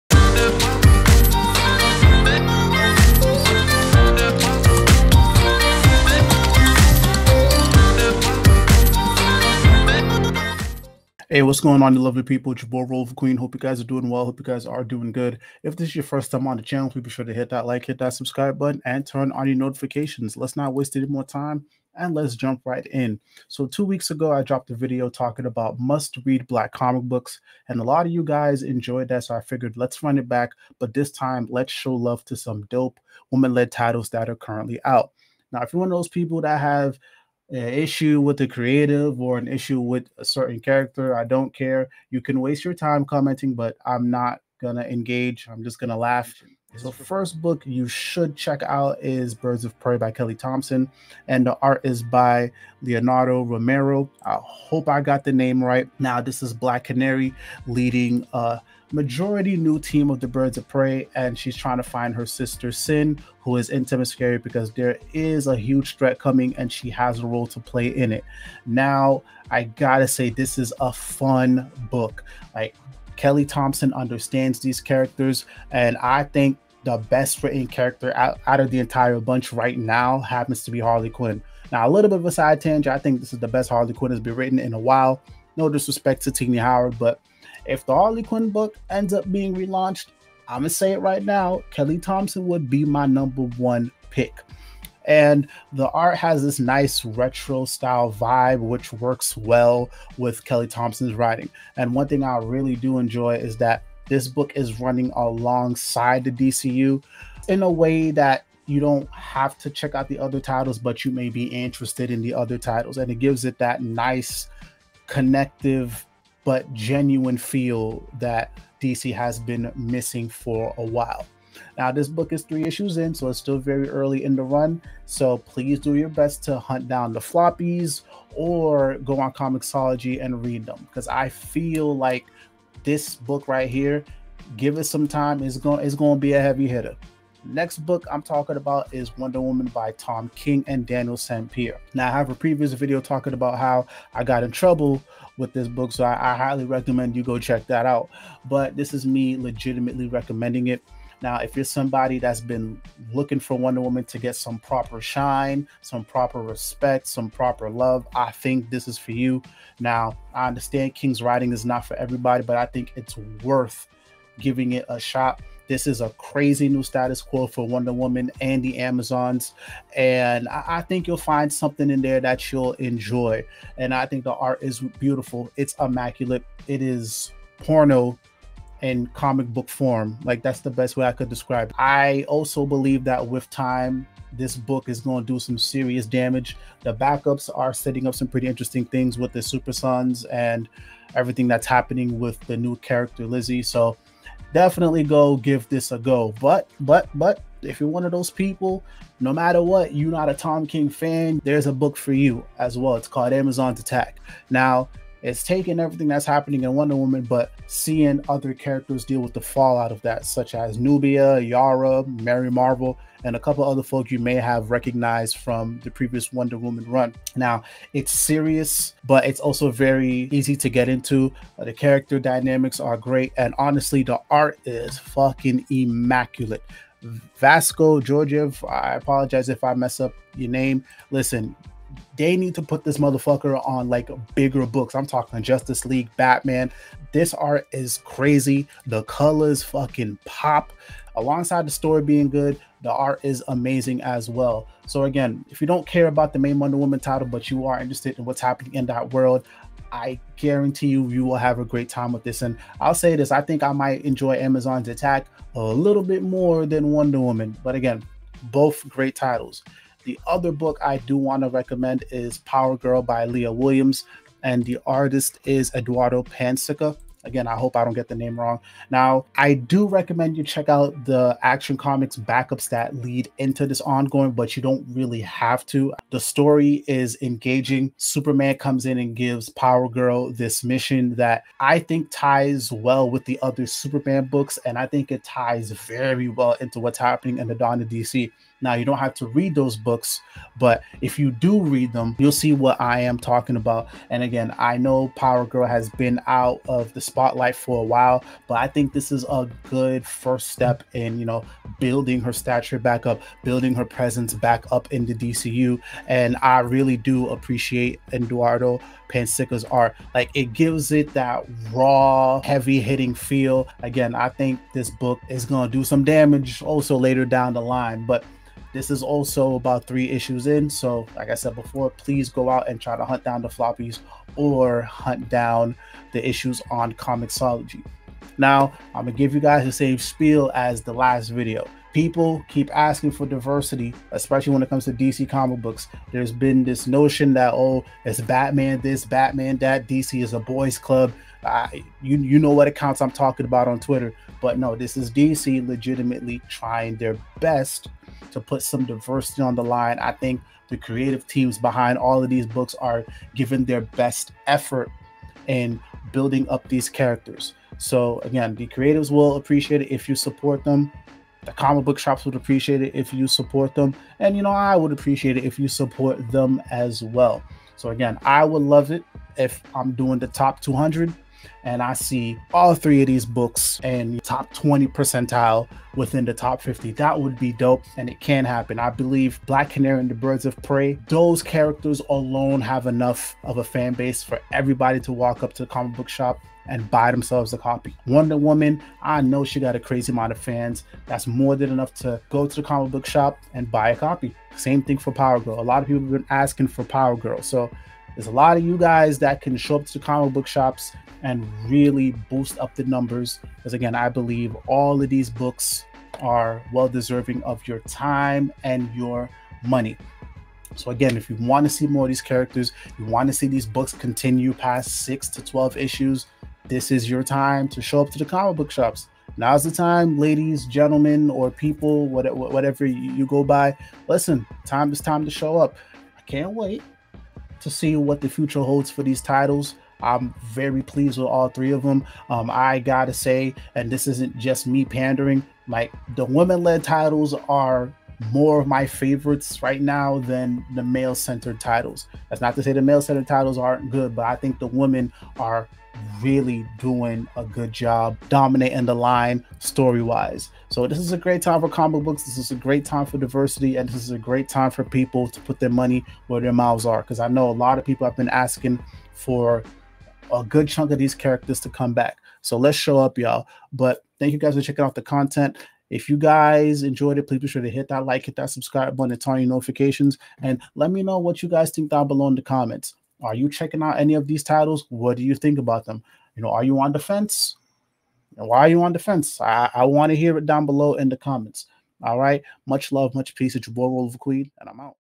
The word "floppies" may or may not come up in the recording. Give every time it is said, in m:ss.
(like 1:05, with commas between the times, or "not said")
2:07, 5:23.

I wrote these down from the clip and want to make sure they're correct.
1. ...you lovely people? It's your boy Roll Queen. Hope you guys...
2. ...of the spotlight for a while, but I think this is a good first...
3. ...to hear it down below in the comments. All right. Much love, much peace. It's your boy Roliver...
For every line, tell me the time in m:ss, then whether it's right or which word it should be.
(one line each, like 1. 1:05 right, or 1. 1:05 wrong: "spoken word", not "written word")
1. 0:11 right
2. 4:56 right
3. 8:00 right.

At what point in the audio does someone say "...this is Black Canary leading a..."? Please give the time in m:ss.
0:56.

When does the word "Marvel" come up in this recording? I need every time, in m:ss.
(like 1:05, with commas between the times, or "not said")
3:32.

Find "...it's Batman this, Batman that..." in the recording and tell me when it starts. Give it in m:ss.
5:38.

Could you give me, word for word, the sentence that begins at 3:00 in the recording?
Like that's the best way I could describe.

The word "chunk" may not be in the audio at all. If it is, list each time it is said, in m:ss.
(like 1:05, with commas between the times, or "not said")
7:40.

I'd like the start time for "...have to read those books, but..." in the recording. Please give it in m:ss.
4:48.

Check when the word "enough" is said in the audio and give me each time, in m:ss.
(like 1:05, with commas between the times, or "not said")
6:22, 6:31.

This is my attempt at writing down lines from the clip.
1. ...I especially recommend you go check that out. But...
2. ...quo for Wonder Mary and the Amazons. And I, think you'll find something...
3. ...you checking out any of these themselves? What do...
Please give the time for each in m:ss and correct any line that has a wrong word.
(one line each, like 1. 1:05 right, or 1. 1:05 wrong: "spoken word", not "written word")
1. 2:26 wrong: "highly", not "especially"
2. 2:47 wrong: "Woman", not "Mary"
3. 7:53 wrong: "titles", not "themselves".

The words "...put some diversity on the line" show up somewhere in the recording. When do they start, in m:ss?
5:48.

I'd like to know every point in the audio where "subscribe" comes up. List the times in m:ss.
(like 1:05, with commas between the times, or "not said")
0:18, 7:48.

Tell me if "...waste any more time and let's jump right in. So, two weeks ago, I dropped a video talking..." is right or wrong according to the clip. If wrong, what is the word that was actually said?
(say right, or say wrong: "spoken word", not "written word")
right.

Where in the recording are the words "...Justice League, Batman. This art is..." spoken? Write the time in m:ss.
3:55.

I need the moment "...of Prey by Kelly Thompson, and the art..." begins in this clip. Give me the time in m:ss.
0:49.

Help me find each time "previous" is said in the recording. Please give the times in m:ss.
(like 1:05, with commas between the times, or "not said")
2:22, 3:35.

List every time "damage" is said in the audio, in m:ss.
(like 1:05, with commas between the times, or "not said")
3:06, 5:16.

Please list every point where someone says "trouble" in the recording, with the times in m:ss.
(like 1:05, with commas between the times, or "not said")
2:24.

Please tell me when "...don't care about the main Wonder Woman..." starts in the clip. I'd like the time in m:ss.
4:05.